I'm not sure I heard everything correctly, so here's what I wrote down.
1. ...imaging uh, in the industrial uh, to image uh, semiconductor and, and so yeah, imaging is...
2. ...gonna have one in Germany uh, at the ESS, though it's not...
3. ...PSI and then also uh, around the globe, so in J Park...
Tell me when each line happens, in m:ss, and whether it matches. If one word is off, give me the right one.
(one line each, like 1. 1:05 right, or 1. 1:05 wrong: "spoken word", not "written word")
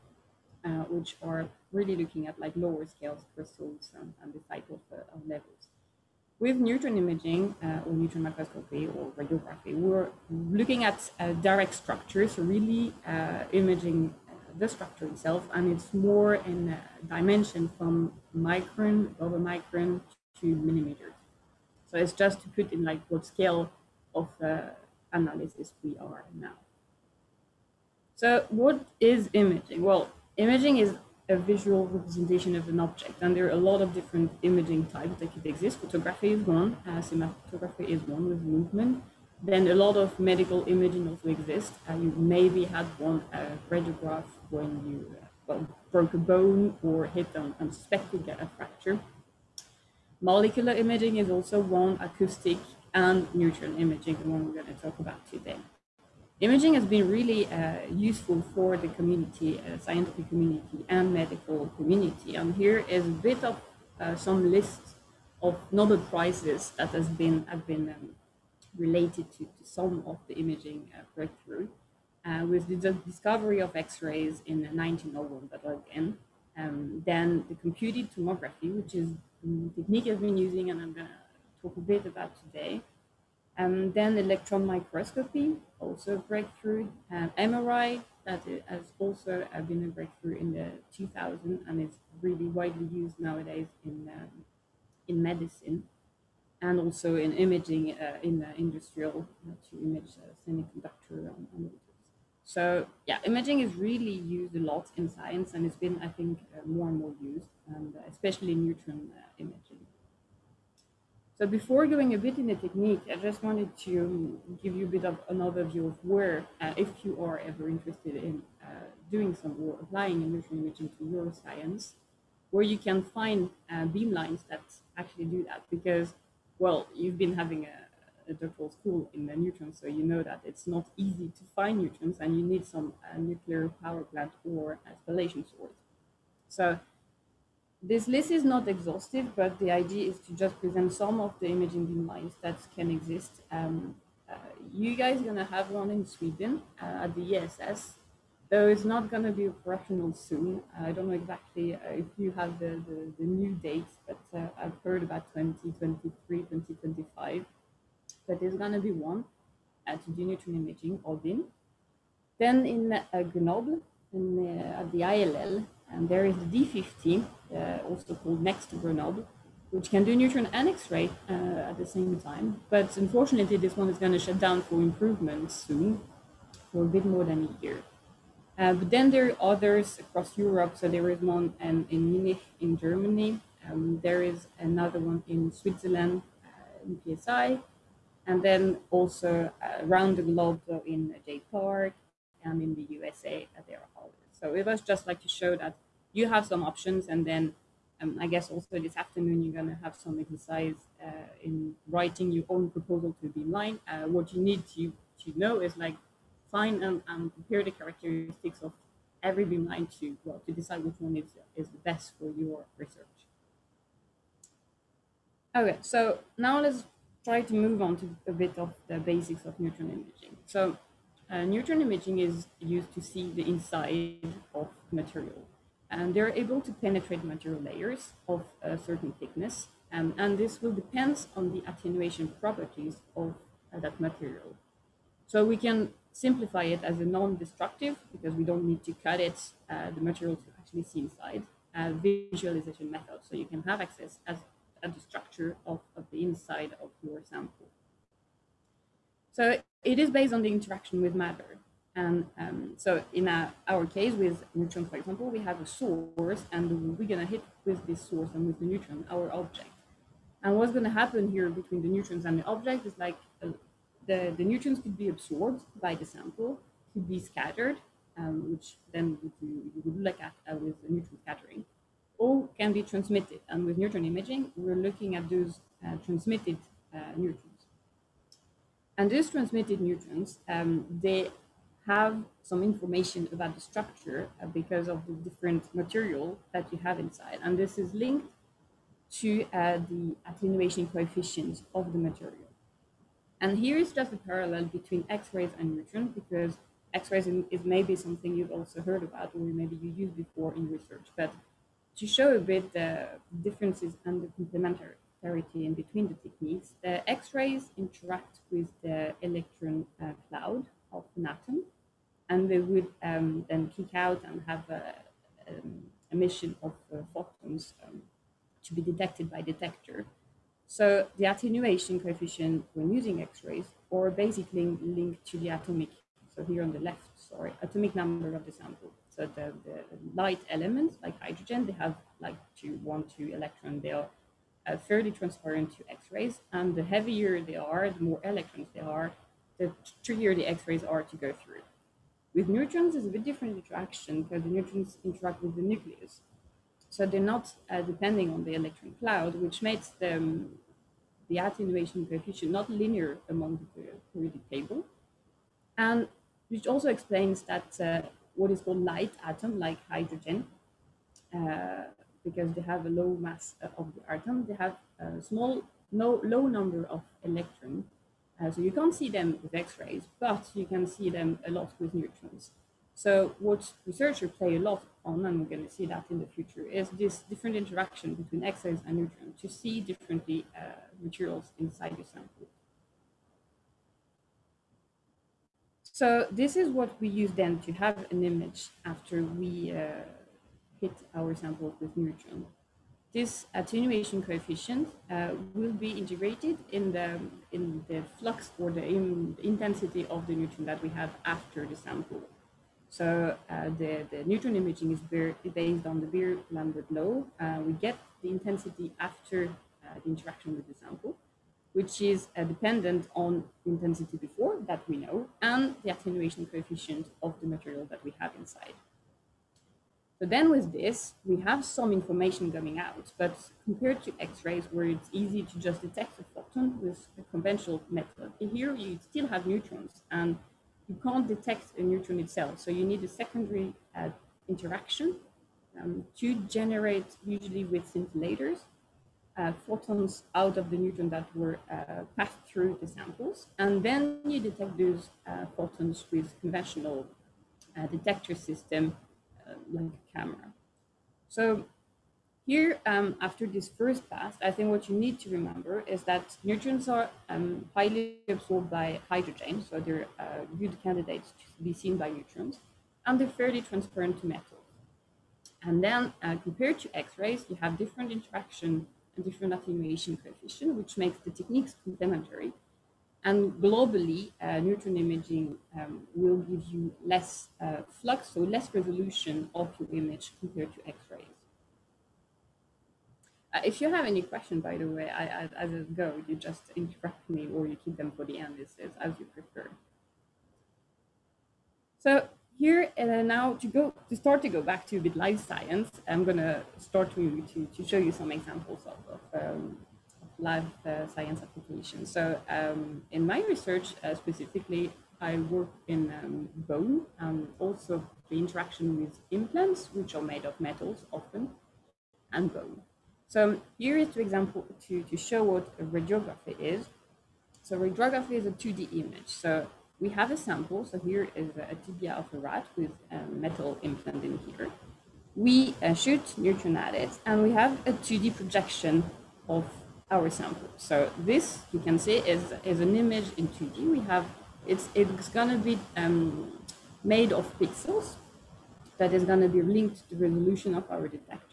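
1. 1:37 right
2. 2:25 wrong: "Sweden", not "Germany"
3. 3:07 right.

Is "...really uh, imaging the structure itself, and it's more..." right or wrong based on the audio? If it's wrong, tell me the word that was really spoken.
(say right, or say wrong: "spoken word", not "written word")
right.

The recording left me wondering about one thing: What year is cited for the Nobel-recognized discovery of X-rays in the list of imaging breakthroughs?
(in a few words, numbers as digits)
1901.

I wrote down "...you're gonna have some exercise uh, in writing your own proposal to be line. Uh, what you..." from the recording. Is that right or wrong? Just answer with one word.
right.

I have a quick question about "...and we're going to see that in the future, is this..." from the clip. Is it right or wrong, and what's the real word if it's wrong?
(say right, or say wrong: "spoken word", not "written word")
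right.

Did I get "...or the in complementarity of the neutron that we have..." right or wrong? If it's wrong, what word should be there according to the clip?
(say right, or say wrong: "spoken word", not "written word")
wrong: "intensity", not "complementarity".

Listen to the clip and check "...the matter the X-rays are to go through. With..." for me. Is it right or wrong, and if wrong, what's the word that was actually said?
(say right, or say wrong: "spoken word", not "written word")
wrong: "trickier", not "matter".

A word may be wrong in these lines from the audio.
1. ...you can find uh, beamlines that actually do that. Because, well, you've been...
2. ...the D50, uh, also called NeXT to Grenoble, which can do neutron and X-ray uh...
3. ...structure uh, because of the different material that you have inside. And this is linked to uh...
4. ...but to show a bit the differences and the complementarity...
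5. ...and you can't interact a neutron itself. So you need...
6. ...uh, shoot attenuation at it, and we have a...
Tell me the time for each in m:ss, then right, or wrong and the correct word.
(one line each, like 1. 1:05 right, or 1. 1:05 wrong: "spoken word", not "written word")
1. 2:02 right
2. 2:46 right
3. 4:43 right
4. 5:01 right
5. 7:10 wrong: "detect", not "interact"
6. 8:45 wrong: "neutron", not "attenuation".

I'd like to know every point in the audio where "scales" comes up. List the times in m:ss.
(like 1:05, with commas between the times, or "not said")
0:02, 0:23.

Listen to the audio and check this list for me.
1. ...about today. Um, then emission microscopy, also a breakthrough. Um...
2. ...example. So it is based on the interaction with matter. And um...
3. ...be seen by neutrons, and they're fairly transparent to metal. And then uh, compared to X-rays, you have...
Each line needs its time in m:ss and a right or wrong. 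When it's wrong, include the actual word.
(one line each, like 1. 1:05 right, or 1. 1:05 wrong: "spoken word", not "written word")
1. 1:22 wrong: "electron", not "emission"
2. 4:07 wrong: "sample", not "example"
3. 7:41 right.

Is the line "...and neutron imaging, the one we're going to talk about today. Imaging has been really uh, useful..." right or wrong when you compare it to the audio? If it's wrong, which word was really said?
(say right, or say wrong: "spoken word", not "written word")
right.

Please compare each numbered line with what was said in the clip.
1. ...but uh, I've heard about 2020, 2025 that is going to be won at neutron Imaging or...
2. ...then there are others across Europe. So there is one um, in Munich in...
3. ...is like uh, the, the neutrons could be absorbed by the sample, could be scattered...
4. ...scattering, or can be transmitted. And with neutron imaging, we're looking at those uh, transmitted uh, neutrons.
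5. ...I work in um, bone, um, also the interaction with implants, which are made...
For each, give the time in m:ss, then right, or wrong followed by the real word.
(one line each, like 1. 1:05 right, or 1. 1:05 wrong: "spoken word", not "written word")
1. 2:34 wrong: "2023", not "2020"
2. 2:58 right
3. 4:22 right
4. 4:31 right
5. 8:25 right.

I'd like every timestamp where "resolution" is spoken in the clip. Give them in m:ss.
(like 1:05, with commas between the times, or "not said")
7:58, 9:00.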